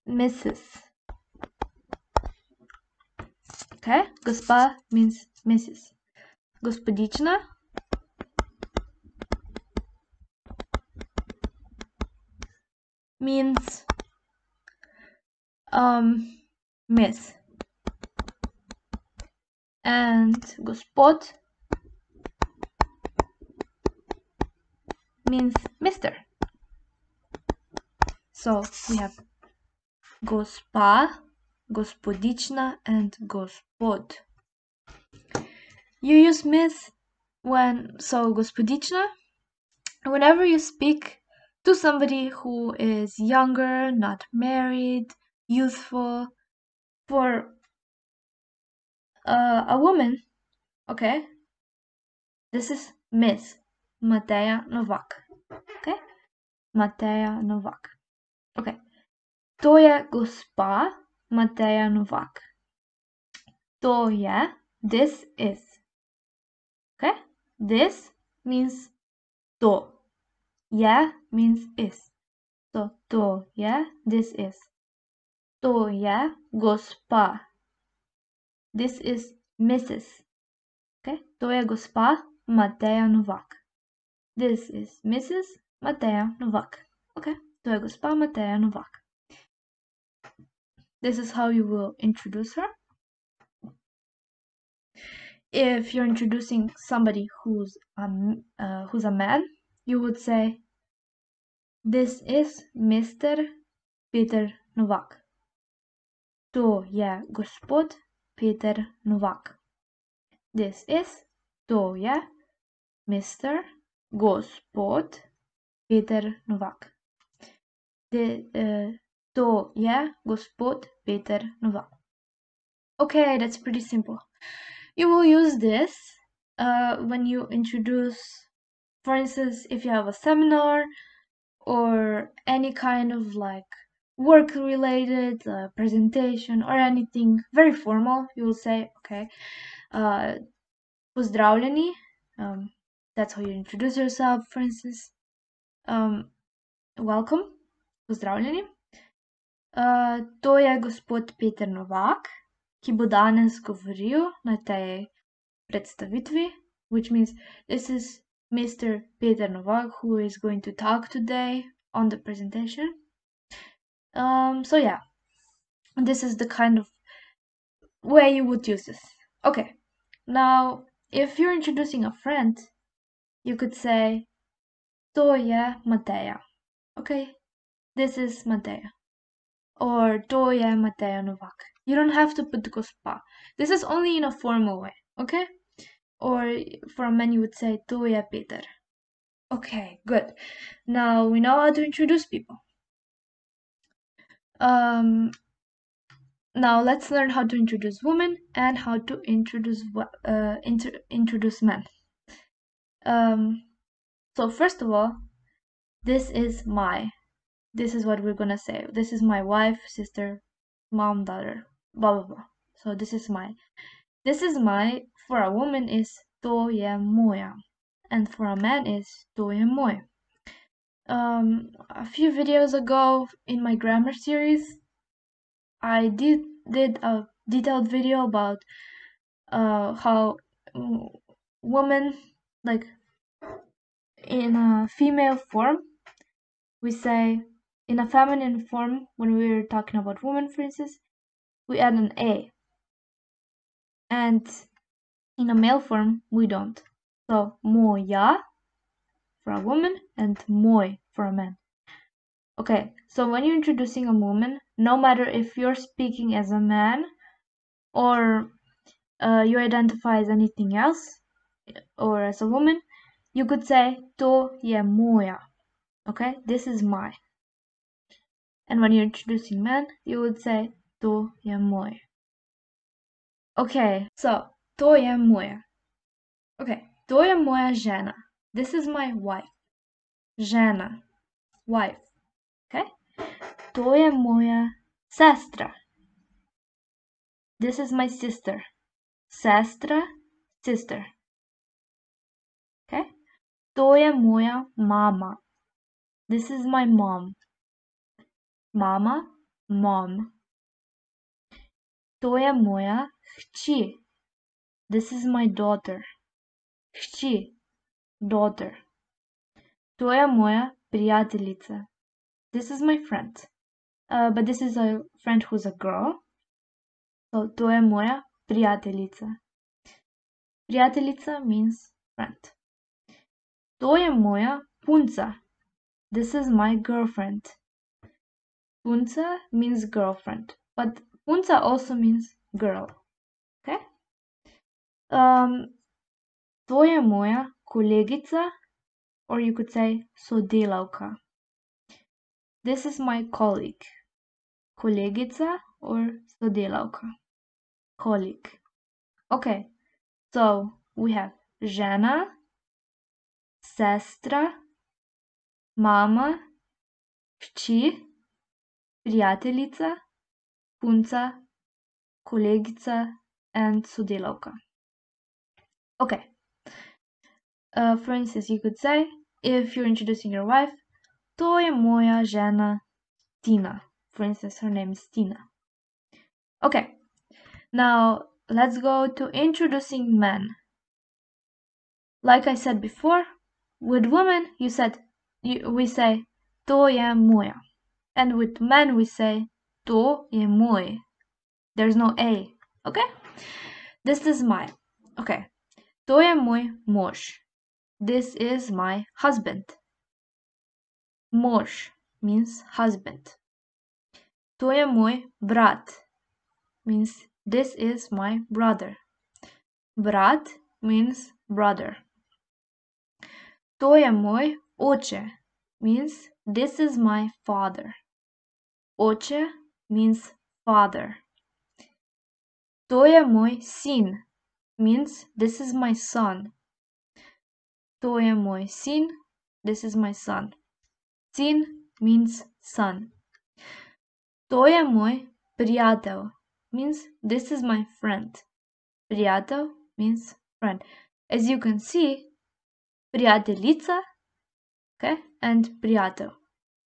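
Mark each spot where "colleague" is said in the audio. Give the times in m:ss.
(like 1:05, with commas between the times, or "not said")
5:43, 5:47.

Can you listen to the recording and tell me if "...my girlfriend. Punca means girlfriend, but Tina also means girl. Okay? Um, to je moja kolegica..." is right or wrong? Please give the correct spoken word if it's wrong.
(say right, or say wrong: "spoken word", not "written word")
wrong: "Unza", not "Tina".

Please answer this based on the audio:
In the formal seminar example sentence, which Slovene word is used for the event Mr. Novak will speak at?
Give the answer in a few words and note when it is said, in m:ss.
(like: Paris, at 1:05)
predstavitvi, at 2:35.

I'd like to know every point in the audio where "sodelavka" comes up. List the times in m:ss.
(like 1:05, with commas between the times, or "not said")
5:40, 5:46, 6:03.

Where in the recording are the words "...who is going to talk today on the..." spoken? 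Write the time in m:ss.
2:40.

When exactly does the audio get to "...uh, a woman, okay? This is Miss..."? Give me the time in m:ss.
0:49.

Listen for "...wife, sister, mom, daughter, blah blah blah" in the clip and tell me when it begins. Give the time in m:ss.
3:29.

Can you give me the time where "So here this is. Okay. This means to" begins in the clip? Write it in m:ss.
1:03.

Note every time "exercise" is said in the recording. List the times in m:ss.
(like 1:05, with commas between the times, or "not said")
not said.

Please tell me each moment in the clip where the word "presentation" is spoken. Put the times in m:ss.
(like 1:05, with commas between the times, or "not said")
2:15, 2:42.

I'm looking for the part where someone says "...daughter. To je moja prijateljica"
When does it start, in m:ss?
5:08.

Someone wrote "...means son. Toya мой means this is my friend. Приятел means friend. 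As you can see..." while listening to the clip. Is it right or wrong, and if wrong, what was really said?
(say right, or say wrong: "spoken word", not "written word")
right.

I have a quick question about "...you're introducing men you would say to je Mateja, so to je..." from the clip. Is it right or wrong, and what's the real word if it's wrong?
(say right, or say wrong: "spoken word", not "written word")
wrong: "Okay", not "Mateja".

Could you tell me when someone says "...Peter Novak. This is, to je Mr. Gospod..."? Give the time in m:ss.
1:48.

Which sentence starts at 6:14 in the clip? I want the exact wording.
For instance, her name is Tina.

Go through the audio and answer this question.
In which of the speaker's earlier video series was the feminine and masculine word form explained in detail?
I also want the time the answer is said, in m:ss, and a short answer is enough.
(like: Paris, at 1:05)
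grammar series, at 3:43.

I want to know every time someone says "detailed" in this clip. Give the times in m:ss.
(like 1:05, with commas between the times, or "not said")
3:47.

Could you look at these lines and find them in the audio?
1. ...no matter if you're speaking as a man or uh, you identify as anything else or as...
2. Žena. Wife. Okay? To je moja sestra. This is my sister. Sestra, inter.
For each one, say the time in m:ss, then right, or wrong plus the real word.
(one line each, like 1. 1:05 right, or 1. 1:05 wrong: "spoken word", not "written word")
1. 4:14 right
2. 4:40 wrong: "sister", not "inter".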